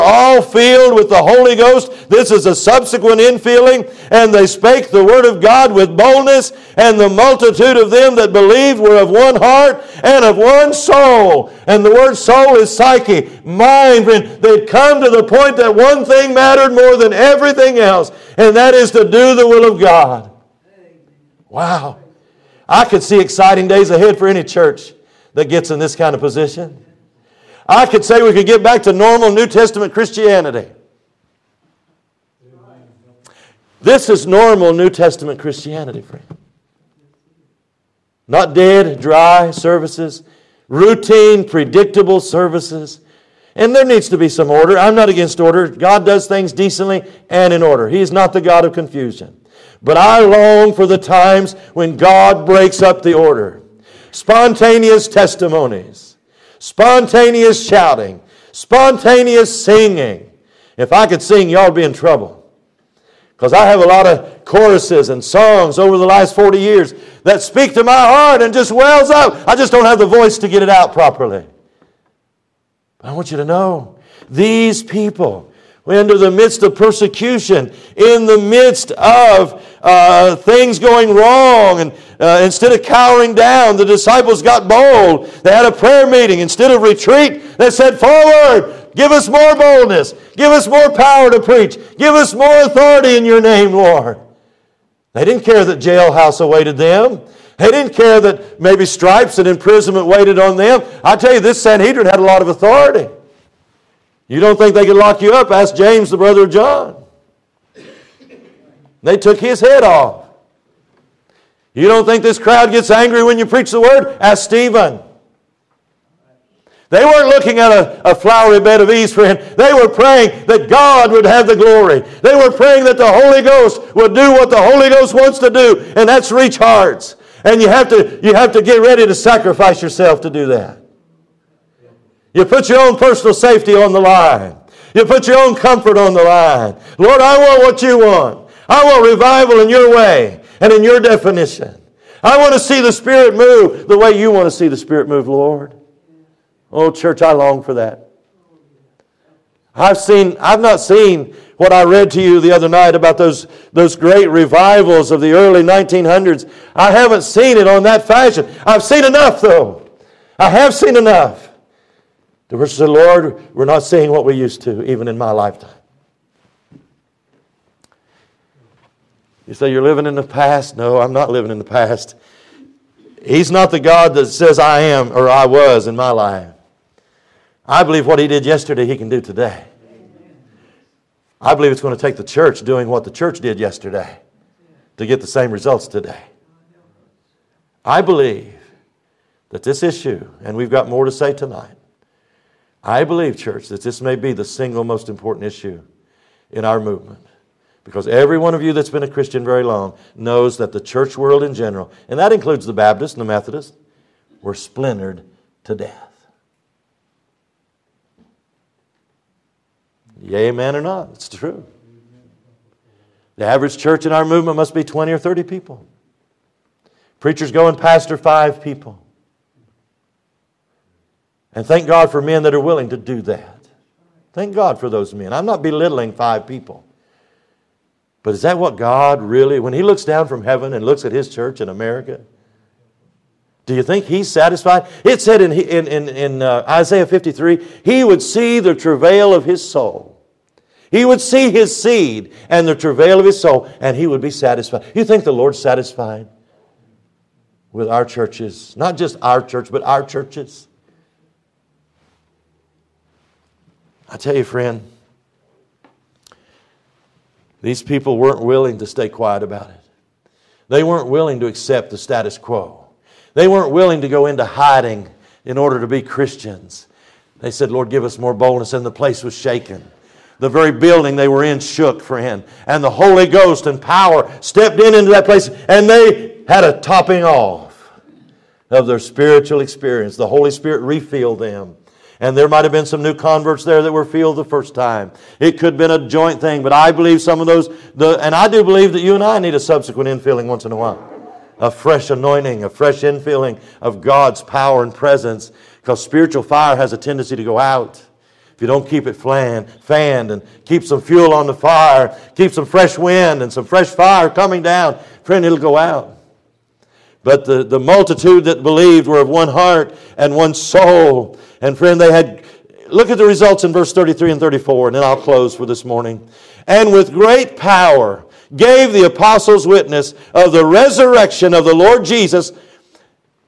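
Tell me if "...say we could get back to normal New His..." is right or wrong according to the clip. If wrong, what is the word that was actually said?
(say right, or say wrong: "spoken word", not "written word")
wrong: "Testament", not "His".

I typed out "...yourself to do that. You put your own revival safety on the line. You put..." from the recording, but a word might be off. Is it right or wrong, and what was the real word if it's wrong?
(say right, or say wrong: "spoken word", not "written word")
wrong: "personal", not "revival".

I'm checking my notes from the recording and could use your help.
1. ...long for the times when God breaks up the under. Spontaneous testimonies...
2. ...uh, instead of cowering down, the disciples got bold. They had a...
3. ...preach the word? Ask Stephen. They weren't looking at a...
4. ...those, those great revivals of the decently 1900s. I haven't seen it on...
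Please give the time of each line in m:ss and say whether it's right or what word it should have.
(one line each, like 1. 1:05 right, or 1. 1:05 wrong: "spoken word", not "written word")
1. 0:50 wrong: "order", not "under"
2. 1:22 right
3. 1:53 right
4. 2:33 wrong: "early", not "decently".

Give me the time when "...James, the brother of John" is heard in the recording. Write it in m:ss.
1:45.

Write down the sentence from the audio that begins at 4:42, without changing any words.
And there might have been some new converts there that were filled the first time.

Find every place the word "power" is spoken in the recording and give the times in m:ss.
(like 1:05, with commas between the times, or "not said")
1:30, 4:33, 4:54, 5:17.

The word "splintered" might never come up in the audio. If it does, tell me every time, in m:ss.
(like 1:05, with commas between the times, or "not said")
3:24.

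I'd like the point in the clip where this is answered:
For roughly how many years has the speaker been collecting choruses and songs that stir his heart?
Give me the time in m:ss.
1:06.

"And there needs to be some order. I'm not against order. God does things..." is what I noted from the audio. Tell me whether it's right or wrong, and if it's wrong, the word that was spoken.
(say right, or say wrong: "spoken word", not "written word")
right.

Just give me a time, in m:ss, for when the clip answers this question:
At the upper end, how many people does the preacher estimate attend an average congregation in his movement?
3:35.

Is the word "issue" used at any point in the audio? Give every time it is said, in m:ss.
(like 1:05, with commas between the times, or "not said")
3:09, 3:15.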